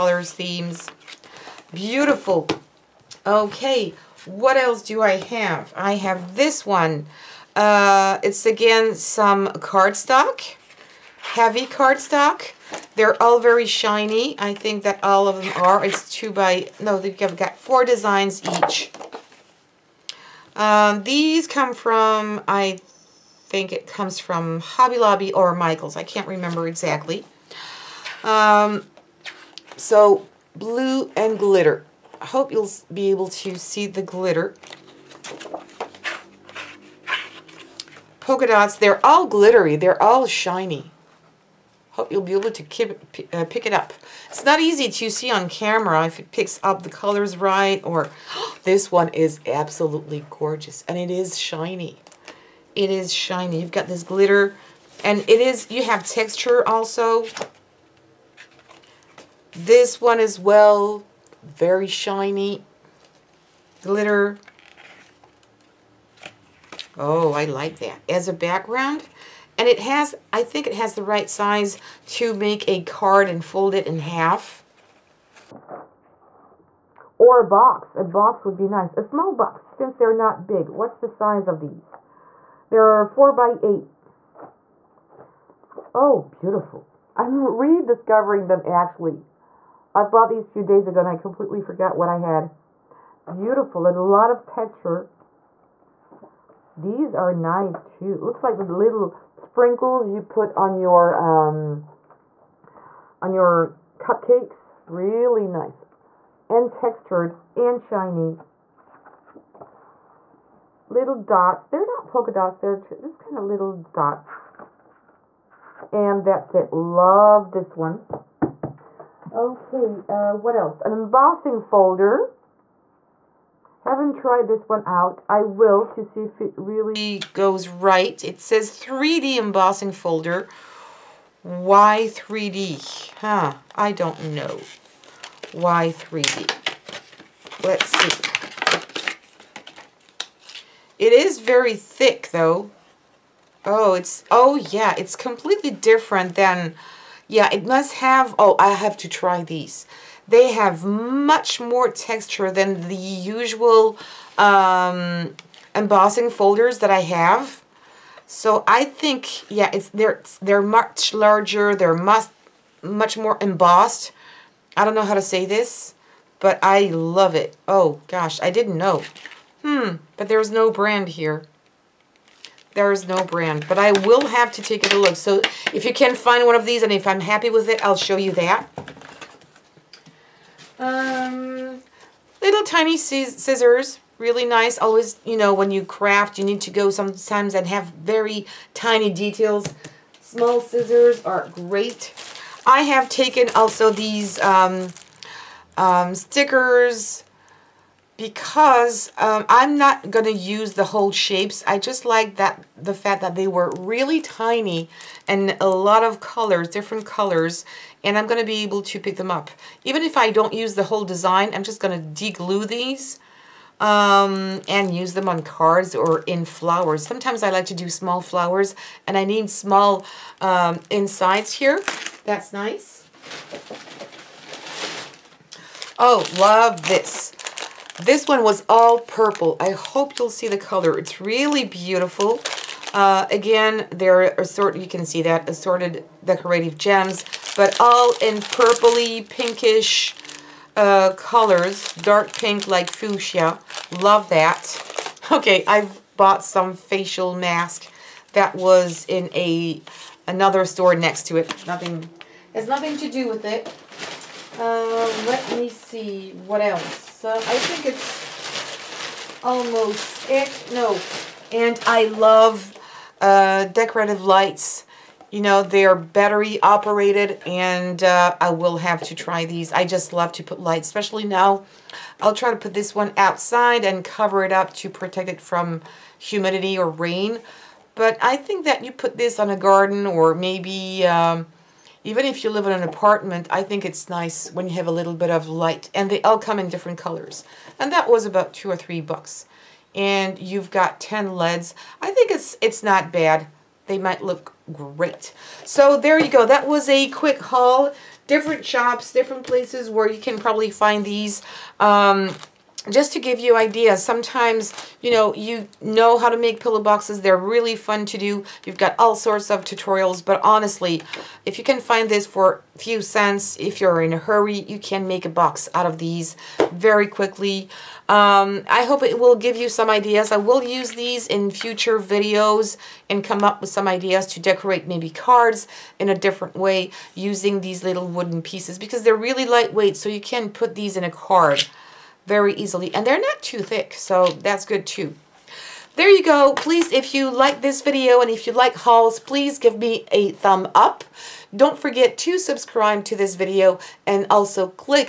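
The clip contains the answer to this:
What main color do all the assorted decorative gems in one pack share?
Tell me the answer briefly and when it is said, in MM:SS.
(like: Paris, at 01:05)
Purple, at 03:48.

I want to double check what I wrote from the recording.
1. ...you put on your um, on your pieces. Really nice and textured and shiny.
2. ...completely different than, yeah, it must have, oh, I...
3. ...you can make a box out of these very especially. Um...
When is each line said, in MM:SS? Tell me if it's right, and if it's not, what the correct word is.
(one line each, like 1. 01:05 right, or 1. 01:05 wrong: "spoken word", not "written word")
1. 01:40 wrong: "cupcakes", not "pieces"
2. 02:25 right
3. 05:14 wrong: "quickly", not "especially".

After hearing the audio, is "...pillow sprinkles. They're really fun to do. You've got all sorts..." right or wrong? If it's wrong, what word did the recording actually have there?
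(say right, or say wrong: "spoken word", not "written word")
wrong: "boxes", not "sprinkles".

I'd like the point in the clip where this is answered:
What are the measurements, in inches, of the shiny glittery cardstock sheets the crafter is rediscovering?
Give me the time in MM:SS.
01:23.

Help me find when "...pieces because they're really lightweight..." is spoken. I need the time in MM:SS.
05:28.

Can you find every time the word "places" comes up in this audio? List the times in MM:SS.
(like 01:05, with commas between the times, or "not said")
04:59.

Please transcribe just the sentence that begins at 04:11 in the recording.
Nothing has nothing to do with it.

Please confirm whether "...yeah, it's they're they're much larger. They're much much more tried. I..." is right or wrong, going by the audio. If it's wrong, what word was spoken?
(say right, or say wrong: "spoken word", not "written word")
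wrong: "embossed", not "tried".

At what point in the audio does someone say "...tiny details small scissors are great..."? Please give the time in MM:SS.
03:08.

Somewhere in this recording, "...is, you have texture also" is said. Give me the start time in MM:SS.
00:55.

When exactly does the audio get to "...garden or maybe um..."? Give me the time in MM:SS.
04:39.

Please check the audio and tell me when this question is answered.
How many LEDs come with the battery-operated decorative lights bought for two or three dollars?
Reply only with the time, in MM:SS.
04:50.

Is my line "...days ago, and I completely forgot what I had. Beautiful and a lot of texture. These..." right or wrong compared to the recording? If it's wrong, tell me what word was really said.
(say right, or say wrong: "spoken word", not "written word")
right.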